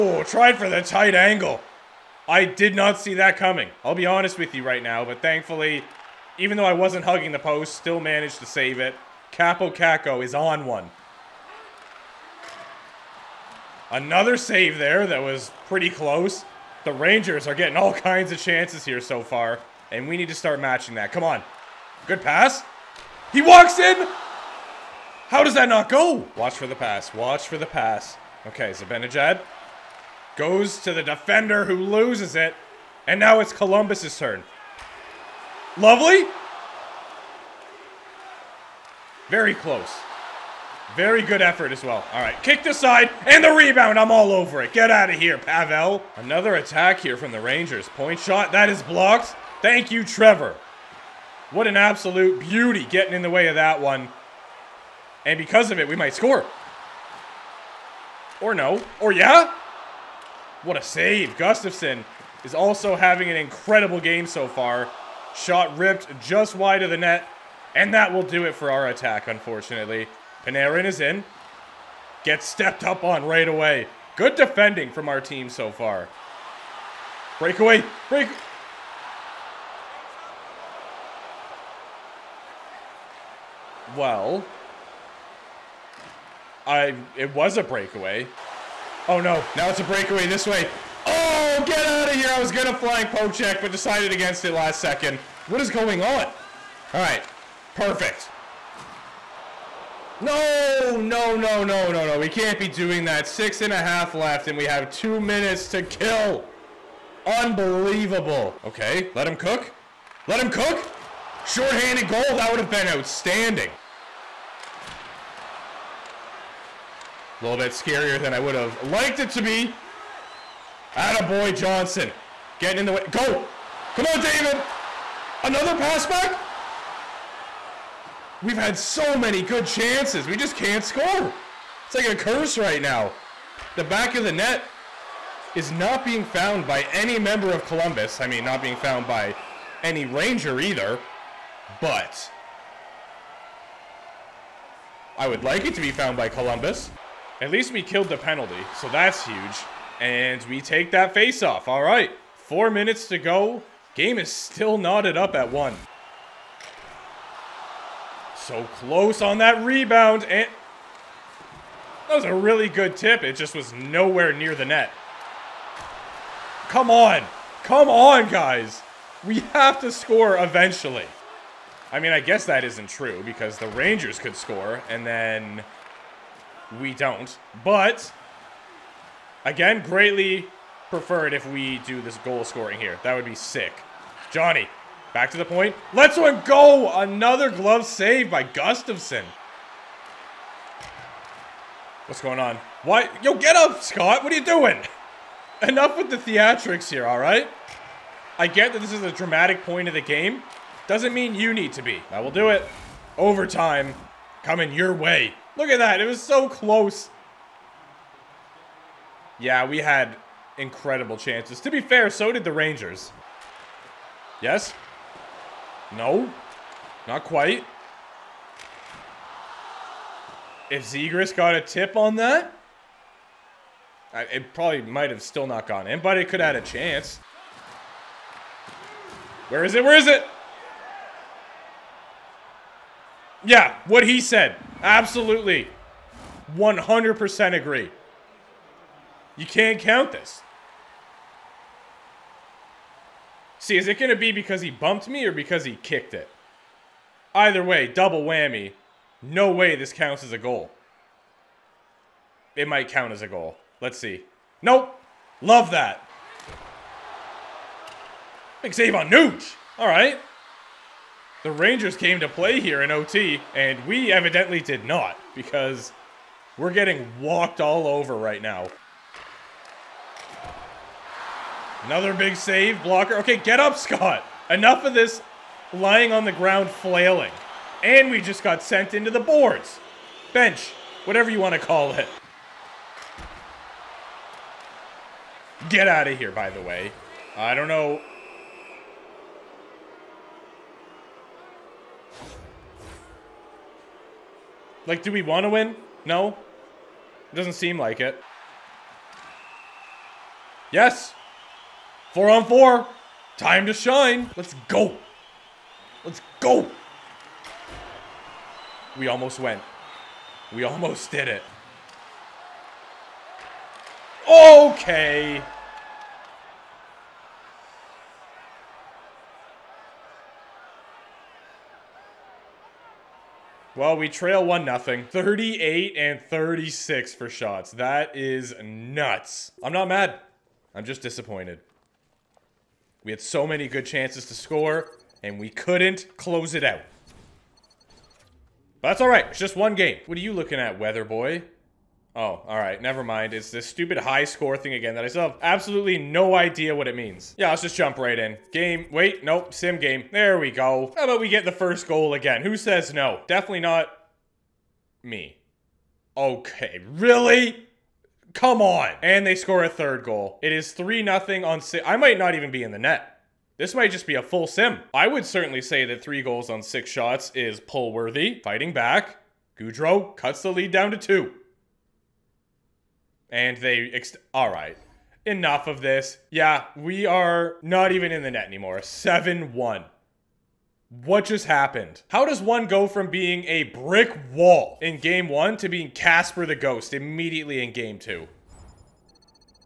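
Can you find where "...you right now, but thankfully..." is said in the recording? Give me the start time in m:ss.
0:04.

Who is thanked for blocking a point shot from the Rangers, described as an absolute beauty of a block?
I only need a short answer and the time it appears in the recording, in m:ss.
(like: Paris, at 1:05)
Trevor, at 0:50.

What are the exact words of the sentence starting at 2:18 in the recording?
I mean, not being found by any Ranger either.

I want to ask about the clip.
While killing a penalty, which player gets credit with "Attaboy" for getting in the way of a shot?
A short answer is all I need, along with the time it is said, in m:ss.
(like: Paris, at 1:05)
Johnson, at 2:01.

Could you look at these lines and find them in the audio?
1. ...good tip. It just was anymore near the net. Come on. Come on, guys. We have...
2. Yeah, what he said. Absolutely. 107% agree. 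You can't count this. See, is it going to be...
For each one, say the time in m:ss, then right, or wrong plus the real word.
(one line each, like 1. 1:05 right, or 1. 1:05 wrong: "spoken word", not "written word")
1. 2:42 wrong: "nowhere", not "anymore"
2. 3:53 wrong: "100", not "107".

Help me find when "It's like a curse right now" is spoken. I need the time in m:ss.
2:11.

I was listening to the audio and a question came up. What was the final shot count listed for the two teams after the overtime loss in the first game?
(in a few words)
38 and 36.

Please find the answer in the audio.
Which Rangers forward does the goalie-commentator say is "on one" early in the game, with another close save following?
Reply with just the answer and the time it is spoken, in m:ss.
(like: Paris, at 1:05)
Kaapo Kakko, at 0:09.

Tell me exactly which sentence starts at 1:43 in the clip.
Six and a half left, and we have two minutes to kill.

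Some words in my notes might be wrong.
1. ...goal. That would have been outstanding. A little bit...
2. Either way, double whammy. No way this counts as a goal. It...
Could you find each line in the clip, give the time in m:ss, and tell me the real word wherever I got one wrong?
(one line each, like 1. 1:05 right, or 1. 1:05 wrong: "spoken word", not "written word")
1. 1:52 right
2. 4:07 right.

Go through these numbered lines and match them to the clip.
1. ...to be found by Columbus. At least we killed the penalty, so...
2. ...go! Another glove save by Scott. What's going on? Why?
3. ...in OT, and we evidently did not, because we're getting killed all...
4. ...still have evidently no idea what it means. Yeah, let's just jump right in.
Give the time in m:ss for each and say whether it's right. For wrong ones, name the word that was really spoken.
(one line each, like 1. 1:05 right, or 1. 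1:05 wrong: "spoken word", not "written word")
1. 2:25 right
2. 3:06 wrong: "Gustavsson", not "Scott"
3. 4:22 wrong: "walked", not "killed"
4. 5:45 wrong: "absolutely", not "evidently".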